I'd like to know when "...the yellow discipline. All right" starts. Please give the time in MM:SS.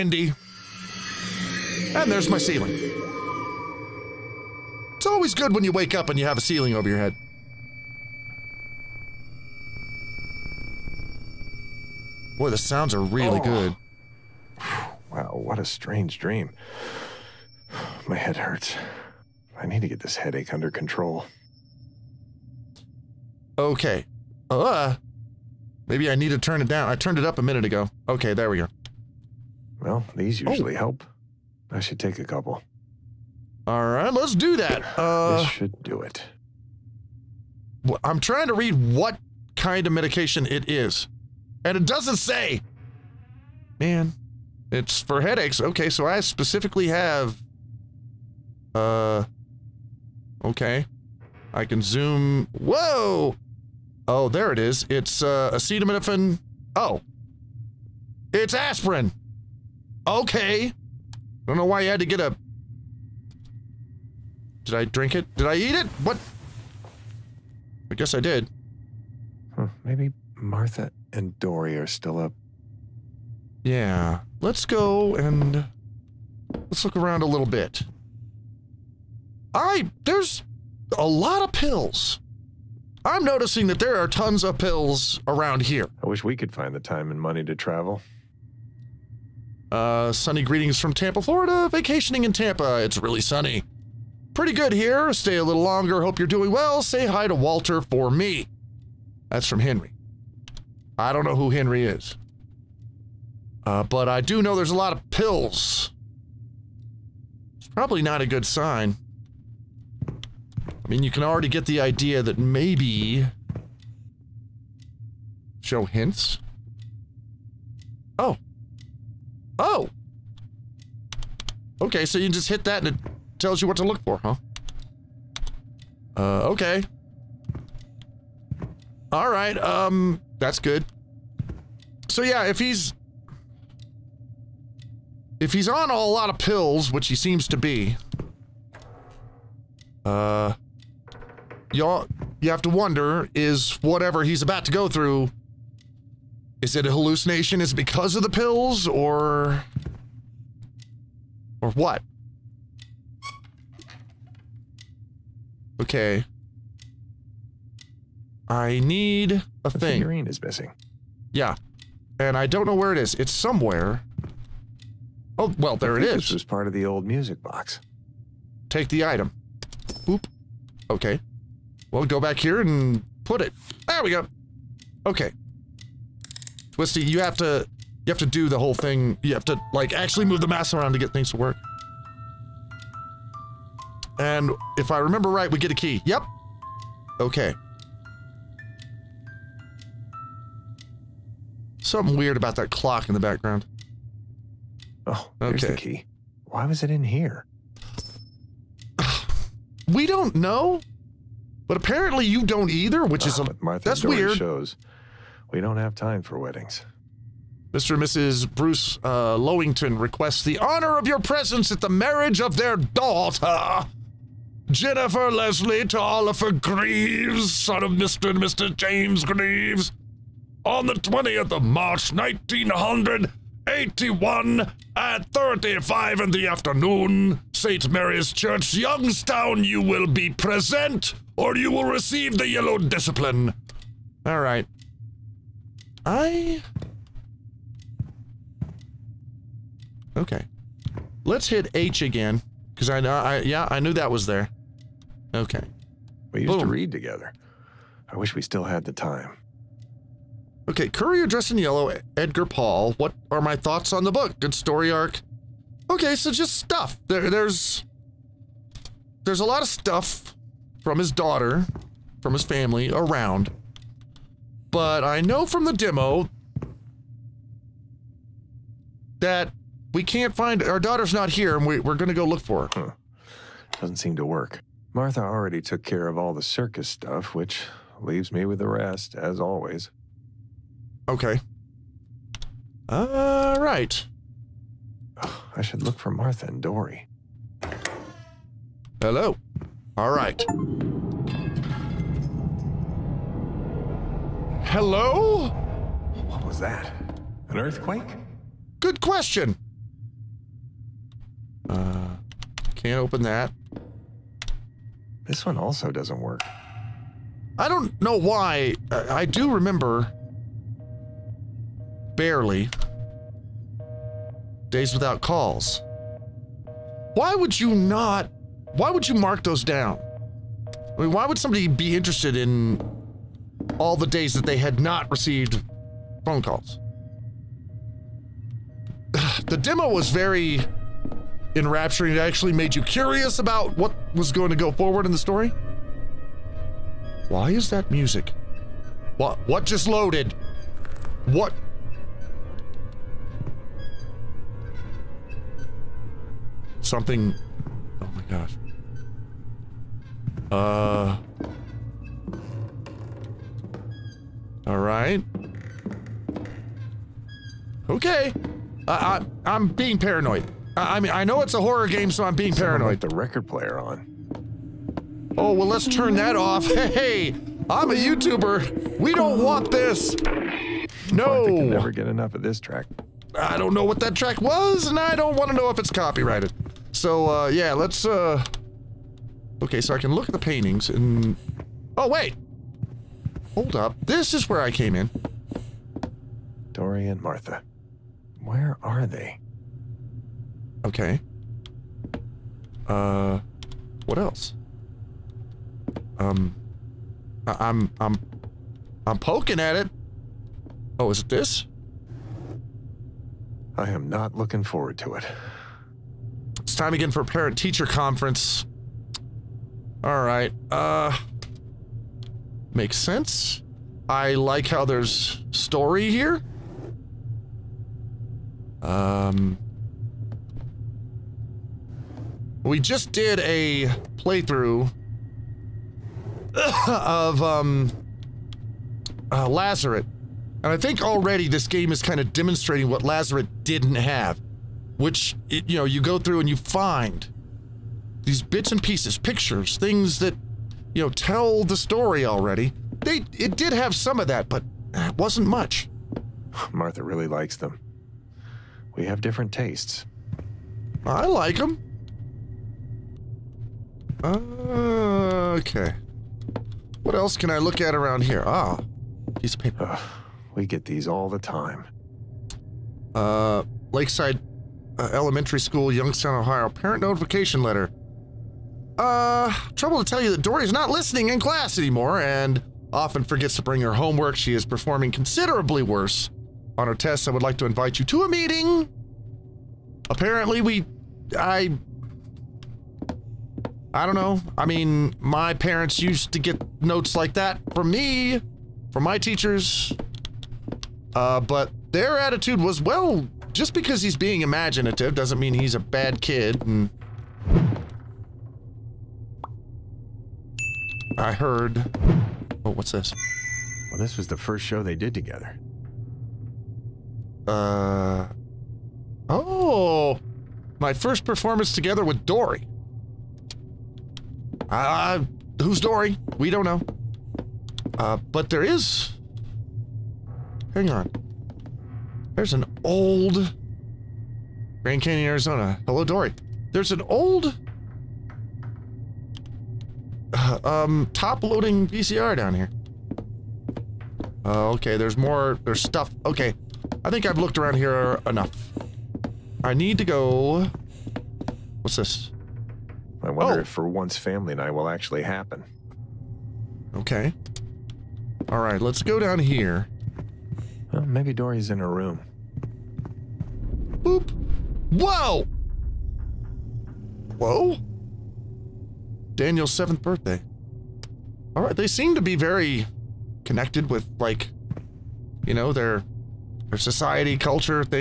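03:52.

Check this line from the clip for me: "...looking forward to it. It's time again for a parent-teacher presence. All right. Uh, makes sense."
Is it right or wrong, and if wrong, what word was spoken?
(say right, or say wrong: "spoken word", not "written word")
wrong: "conference", not "presence".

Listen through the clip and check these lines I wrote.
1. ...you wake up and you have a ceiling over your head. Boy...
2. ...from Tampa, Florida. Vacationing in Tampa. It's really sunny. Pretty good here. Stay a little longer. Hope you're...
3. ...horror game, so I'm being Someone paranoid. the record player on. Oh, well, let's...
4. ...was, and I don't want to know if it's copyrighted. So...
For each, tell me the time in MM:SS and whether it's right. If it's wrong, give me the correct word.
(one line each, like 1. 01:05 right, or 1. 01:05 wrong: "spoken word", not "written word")
1. 00:05 right
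2. 01:30 right
3. 06:01 right
4. 06:14 right.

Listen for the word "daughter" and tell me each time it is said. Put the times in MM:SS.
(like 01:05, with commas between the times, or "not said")
03:32, 04:21, 04:30.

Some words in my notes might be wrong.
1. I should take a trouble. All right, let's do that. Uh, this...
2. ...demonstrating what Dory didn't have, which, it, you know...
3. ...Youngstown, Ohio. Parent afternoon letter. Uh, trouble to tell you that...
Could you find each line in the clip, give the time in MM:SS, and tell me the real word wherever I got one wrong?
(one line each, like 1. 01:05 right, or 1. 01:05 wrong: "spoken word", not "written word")
1. 00:31 wrong: "couple", not "trouble"
2. 07:12 wrong: "Lazarus", not "Dory"
3. 07:45 wrong: "notification", not "afternoon".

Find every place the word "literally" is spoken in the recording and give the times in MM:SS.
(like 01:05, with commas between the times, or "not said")
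not said.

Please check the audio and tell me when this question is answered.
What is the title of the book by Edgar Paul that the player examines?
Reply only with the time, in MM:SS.
04:10.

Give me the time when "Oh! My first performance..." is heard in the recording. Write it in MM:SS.
08:29.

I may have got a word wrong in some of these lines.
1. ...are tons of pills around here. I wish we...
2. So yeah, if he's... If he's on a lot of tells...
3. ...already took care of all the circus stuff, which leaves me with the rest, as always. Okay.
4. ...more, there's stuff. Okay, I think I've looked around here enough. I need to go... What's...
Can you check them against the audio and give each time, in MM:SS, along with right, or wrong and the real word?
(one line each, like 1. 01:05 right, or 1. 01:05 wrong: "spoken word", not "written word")
1. 01:23 right
2. 02:12 wrong: "pills", not "tells"
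3. 04:35 right
4. 08:55 right.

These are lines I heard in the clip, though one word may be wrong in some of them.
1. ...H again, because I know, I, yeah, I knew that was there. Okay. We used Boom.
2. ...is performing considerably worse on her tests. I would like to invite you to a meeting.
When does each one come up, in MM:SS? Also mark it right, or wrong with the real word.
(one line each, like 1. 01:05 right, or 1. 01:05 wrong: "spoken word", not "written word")
1. 04:01 right
2. 07:54 right.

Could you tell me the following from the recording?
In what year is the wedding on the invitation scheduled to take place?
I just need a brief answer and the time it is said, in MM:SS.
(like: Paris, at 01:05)
1981, at 03:42.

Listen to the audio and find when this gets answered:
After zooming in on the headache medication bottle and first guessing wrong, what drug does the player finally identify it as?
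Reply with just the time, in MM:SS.
00:58.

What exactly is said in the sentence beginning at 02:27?
Is because of the pills or.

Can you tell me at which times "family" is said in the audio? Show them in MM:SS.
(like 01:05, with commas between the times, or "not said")
04:22, 09:04.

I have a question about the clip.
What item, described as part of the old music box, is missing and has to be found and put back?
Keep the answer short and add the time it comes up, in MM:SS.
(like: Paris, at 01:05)
Figurine, at 02:40.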